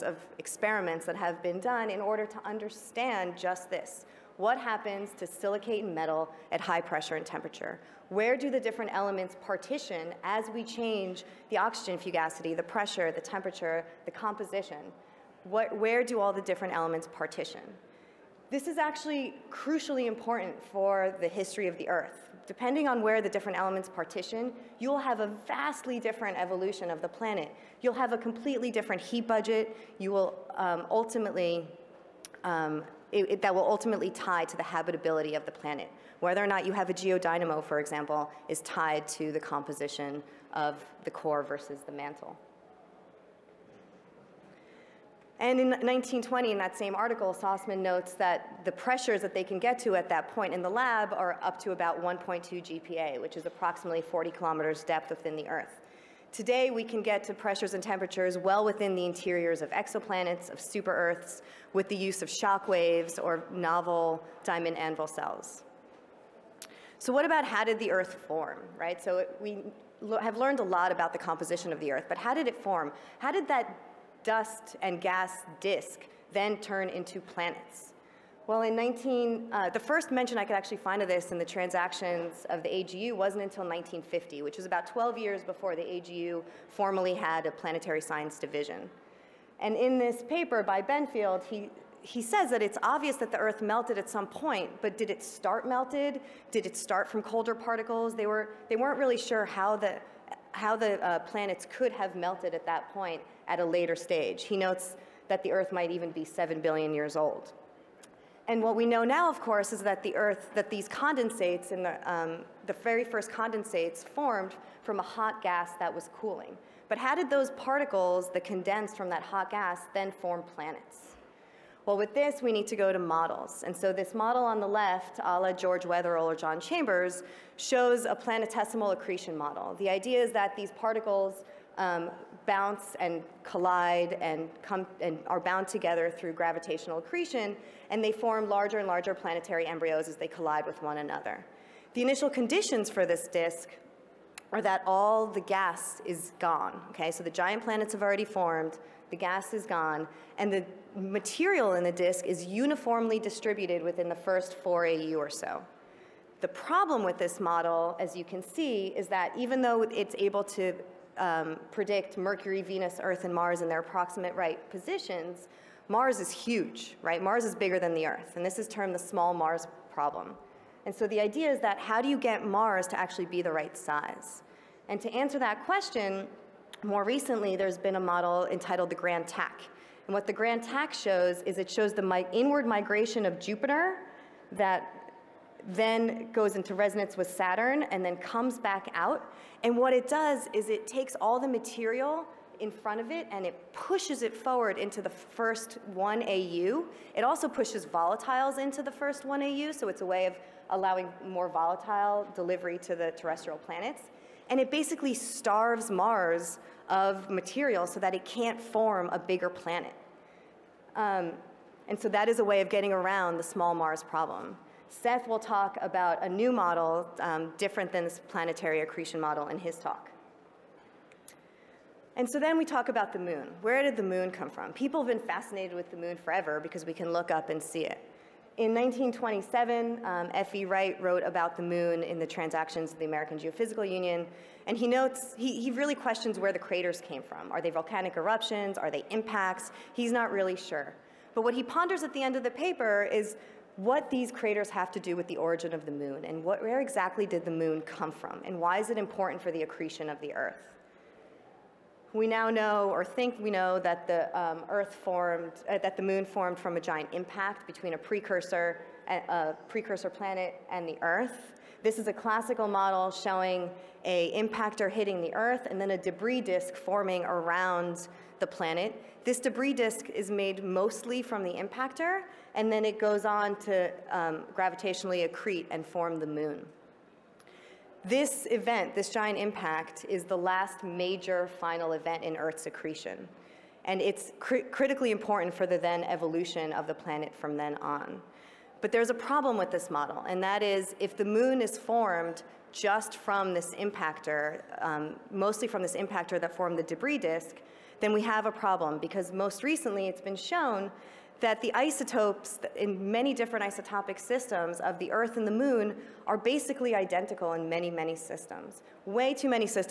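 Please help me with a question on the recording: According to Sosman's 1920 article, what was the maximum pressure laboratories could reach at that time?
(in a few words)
1.2 GPa.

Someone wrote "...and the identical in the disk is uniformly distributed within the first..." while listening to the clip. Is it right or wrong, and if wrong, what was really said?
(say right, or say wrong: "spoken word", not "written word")
wrong: "material", not "identical".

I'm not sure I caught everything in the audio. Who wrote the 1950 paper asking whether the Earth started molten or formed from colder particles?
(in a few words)
Benfield.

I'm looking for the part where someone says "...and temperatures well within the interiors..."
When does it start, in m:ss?
0:57.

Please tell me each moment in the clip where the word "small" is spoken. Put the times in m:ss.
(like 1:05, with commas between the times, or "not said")
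2:48, 3:33.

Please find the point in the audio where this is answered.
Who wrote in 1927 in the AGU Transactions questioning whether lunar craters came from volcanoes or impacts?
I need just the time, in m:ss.
3:50.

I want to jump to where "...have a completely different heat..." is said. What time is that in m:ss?
0:27.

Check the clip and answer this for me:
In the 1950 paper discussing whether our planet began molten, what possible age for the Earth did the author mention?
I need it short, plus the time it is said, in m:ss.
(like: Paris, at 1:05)
7 billion years, at 1:46.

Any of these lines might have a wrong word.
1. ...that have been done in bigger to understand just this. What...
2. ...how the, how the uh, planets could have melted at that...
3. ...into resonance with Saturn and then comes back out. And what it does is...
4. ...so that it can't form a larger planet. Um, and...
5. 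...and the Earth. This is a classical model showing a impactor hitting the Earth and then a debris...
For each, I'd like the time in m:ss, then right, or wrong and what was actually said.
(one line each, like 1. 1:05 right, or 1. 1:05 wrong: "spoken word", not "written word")
1. 0:01 wrong: "order", not "bigger"
2. 1:39 right
3. 3:06 right
4. 3:27 wrong: "bigger", not "larger"
5. 4:20 right.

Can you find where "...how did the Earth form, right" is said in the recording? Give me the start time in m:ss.
1:07.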